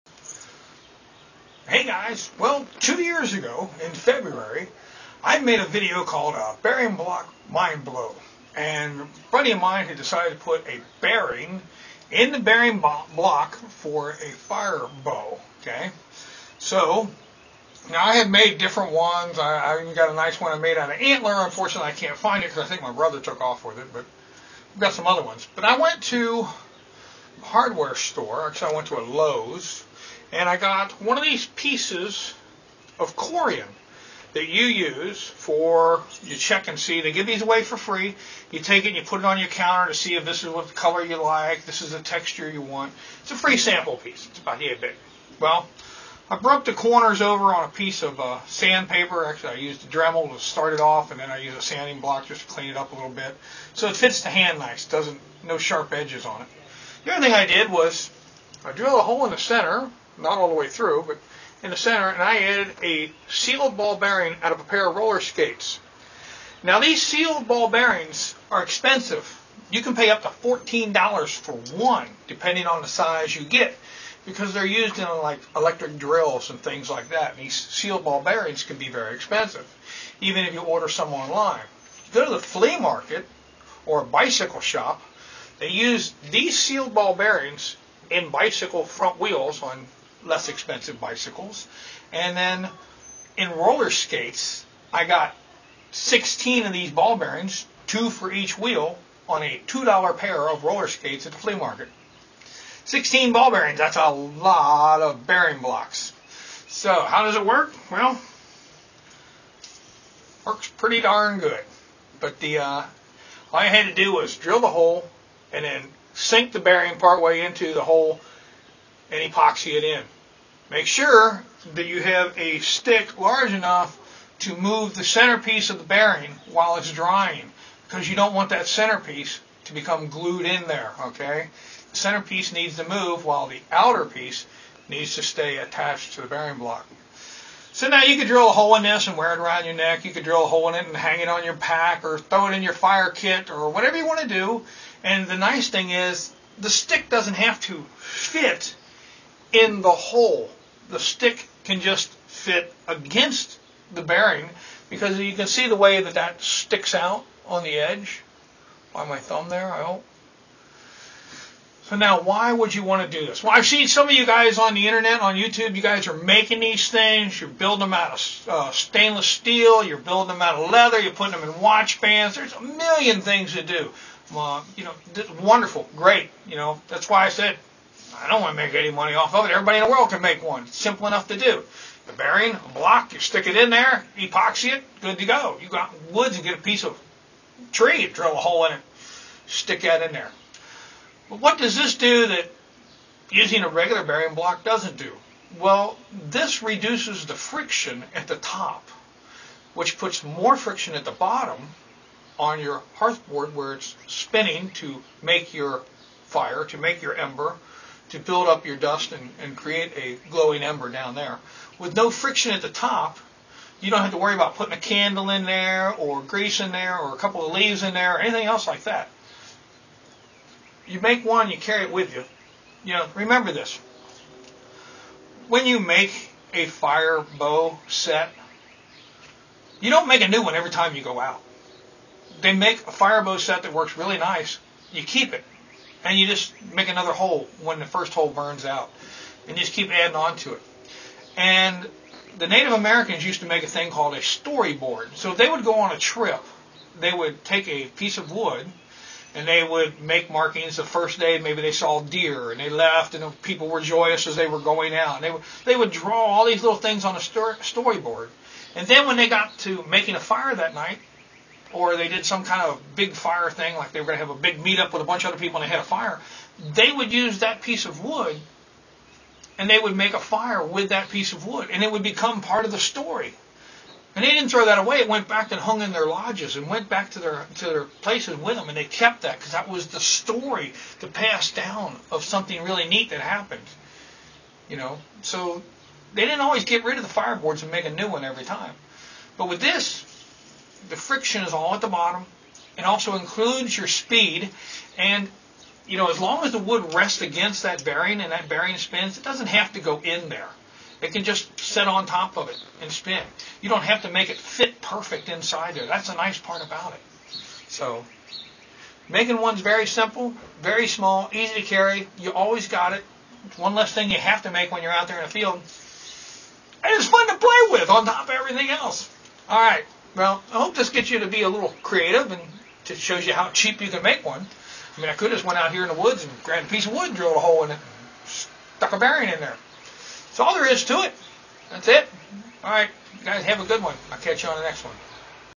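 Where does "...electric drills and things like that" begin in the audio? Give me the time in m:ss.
1:15.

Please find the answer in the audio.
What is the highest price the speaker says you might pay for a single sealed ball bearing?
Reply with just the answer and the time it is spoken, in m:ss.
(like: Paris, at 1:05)
$14, at 1:10.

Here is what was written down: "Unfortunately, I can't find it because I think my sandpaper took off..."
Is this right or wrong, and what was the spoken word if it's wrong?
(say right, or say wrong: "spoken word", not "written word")
wrong: "brother", not "sandpaper".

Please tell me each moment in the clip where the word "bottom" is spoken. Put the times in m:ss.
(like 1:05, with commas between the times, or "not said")
3:21, 4:51.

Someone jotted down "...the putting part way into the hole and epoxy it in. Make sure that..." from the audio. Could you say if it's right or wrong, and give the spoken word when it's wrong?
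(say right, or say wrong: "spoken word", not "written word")
wrong: "bearing", not "putting".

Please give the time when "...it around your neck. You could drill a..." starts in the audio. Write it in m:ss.
2:19.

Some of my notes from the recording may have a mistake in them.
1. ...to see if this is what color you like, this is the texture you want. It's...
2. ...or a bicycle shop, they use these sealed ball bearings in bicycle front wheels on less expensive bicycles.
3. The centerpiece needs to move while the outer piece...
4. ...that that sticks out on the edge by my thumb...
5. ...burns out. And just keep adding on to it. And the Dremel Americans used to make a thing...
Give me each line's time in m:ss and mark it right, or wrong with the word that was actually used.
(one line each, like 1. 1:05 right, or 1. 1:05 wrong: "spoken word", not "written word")
1. 0:39 right
2. 1:23 right
3. 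2:11 right
4. 2:36 right
5. 3:58 wrong: "Native", not "Dremel".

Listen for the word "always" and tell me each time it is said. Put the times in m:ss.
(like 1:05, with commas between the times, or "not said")
4:46, 5:12.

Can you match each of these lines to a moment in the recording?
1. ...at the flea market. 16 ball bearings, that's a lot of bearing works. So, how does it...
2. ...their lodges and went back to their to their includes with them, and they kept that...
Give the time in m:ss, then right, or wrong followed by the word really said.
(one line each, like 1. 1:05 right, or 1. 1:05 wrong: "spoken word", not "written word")
1. 1:41 wrong: "blocks", not "works"
2. 4:35 wrong: "places", not "includes".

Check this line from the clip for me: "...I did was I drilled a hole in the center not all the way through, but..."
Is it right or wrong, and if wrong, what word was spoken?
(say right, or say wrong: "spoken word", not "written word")
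right.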